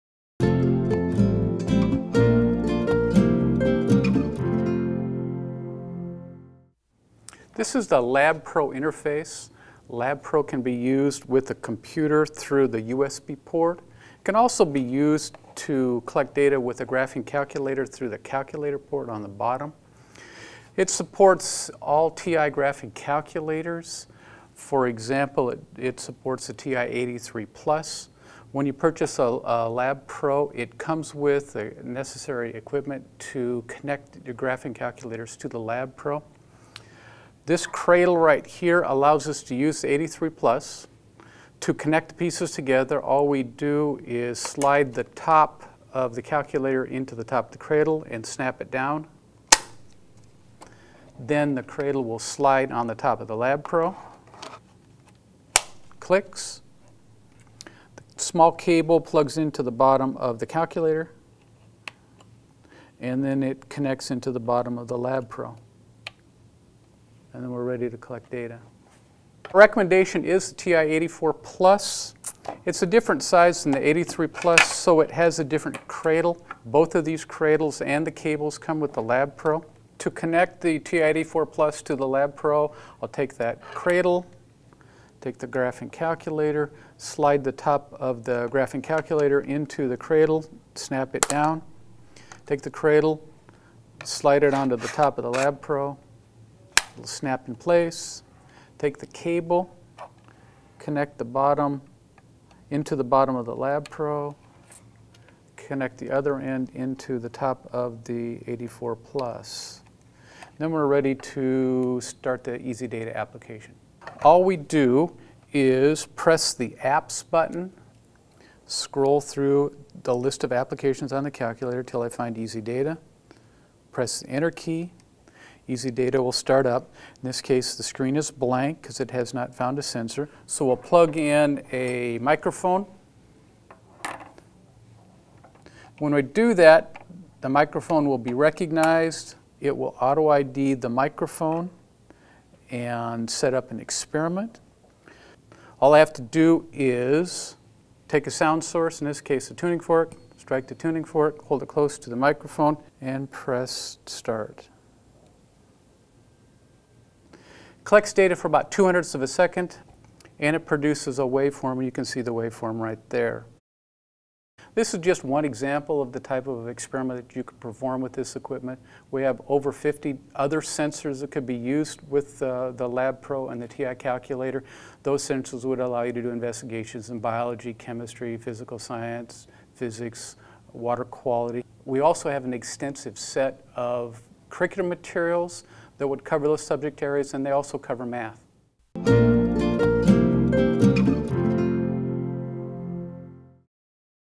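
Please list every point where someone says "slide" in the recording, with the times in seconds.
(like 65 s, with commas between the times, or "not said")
44 s, 52 s, 86 s, 94 s.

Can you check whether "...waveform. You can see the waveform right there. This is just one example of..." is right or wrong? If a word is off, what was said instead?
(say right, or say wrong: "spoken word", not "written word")
right.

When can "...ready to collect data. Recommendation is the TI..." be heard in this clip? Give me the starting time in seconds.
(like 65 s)
67 s.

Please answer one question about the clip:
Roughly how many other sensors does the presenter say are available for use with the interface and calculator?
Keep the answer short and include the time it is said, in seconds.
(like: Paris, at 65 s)
Over 50, at 169 s.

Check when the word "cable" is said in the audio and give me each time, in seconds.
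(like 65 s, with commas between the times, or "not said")
58 s, 78 s, 99 s.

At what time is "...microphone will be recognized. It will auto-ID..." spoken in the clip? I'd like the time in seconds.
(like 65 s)
137 s.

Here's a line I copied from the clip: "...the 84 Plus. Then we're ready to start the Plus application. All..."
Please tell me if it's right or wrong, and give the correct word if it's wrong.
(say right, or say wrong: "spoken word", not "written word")
wrong: "EasyData", not "Plus".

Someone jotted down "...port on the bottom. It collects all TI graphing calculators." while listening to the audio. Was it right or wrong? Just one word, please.
wrong.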